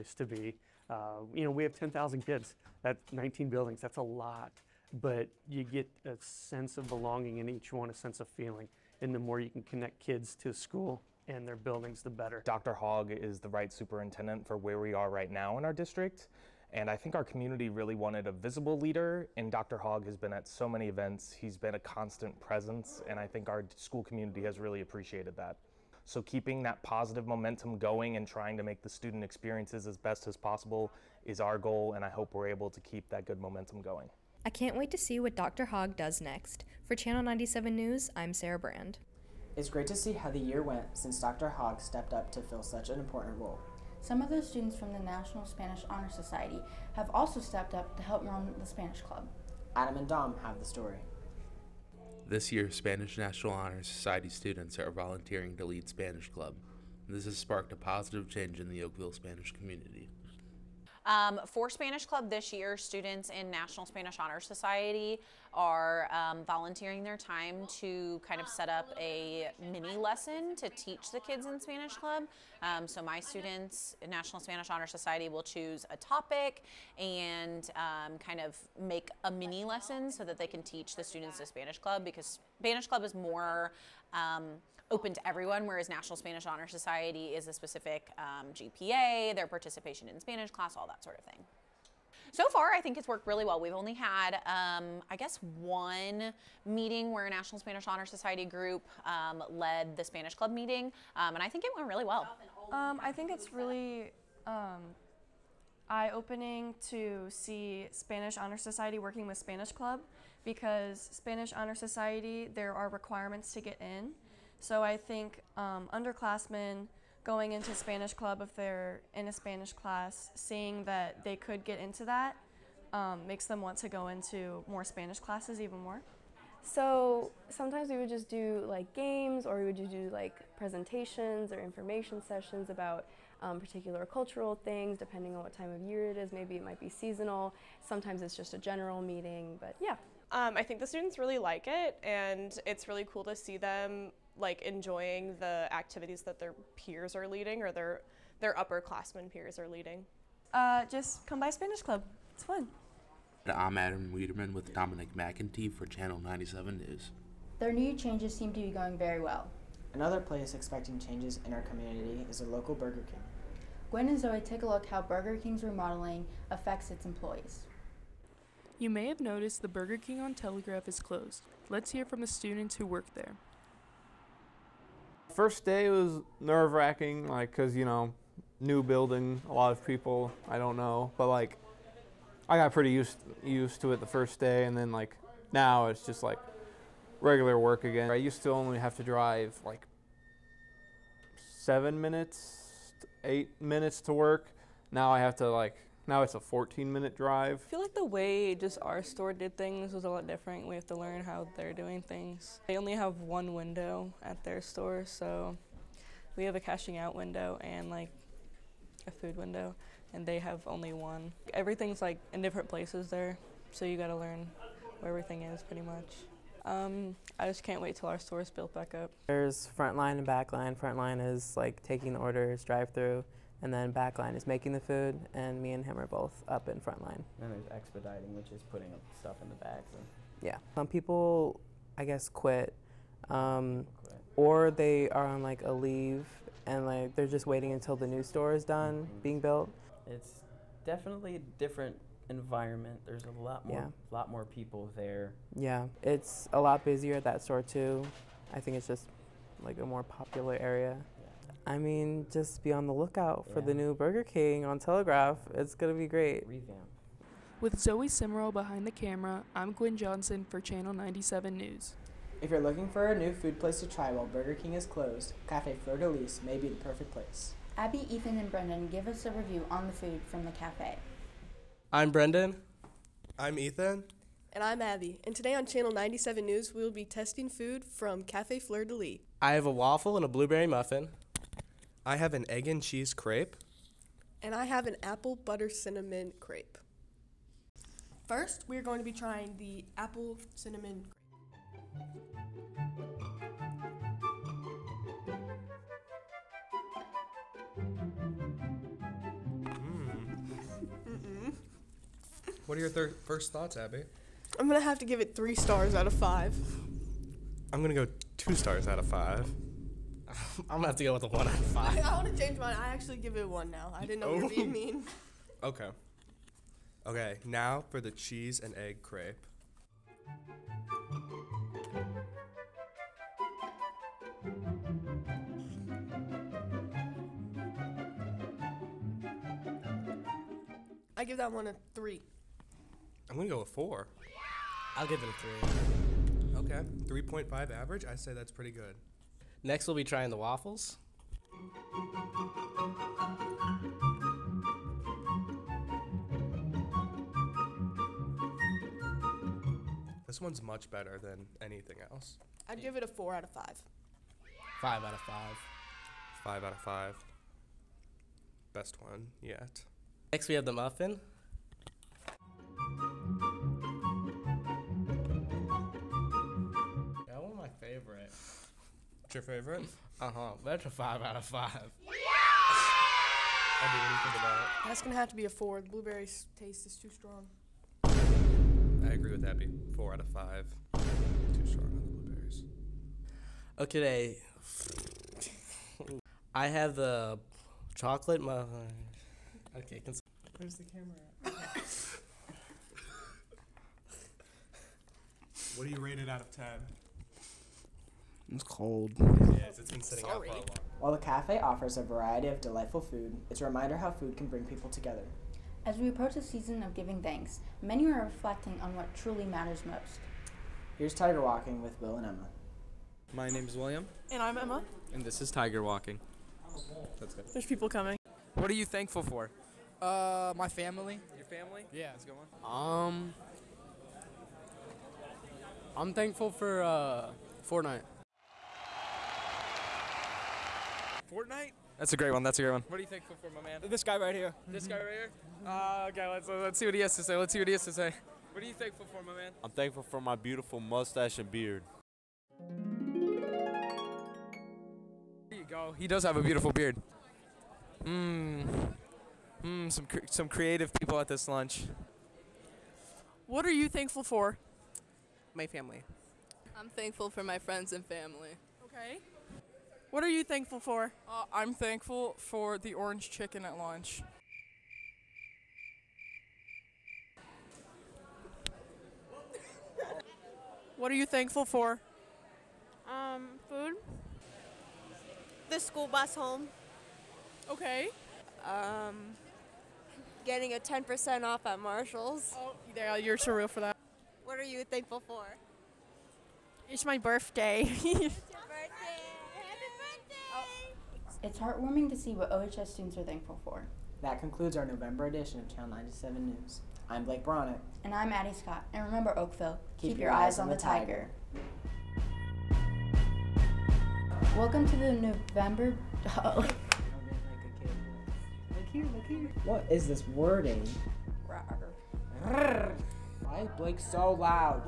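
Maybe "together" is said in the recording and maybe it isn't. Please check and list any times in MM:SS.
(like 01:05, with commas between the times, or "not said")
06:44.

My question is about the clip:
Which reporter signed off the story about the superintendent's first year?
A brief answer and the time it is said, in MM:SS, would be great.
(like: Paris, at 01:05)
Sarah Brand, at 00:38.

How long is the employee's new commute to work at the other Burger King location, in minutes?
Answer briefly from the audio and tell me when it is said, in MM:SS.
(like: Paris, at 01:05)
14, at 03:16.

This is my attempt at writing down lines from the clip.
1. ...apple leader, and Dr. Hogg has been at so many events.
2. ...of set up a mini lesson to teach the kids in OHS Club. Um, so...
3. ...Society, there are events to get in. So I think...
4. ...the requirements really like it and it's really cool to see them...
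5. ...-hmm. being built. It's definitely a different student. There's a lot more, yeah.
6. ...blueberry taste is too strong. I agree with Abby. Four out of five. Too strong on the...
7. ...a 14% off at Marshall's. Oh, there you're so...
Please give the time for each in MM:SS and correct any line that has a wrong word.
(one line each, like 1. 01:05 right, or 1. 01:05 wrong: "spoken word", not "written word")
1. 00:18 wrong: "visible", not "apple"
2. 01:08 wrong: "Spanish", not "OHS"
3. 01:51 wrong: "requirements", not "events"
4. 02:20 wrong: "students", not "requirements"
5. 03:59 wrong: "environment", not "student"
6. 06:15 right
7. 08:00 wrong: "10", not "14".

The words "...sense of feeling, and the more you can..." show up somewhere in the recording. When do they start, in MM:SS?
00:07.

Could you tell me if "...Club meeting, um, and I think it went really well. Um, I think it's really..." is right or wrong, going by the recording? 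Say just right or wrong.
right.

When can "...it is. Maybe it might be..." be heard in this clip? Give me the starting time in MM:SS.
02:16.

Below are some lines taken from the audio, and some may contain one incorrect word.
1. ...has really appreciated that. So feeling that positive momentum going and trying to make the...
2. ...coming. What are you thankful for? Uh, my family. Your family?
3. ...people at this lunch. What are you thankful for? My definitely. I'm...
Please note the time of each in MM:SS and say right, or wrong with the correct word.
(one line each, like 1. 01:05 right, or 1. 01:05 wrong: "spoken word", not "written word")
1. 00:24 wrong: "keeping", not "feeling"
2. 06:57 right
3. 07:30 wrong: "family", not "definitely".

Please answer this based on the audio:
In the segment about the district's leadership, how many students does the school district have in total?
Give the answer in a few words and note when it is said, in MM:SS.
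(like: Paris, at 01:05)
10,000, at 00:01.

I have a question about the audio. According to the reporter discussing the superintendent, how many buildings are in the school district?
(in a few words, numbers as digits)
19.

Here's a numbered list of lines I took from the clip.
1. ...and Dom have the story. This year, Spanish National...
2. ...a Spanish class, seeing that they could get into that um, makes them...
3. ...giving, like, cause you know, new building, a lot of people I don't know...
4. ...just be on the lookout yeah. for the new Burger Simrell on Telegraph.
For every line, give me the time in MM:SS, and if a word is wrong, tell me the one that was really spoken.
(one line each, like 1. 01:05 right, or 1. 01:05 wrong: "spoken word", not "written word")
1. 00:49 right
2. 01:59 right
3. 02:56 wrong: "wracking", not "giving"
4. 04:12 wrong: "King", not "Simrell".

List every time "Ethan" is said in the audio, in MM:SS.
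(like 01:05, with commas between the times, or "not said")
04:28, 04:33.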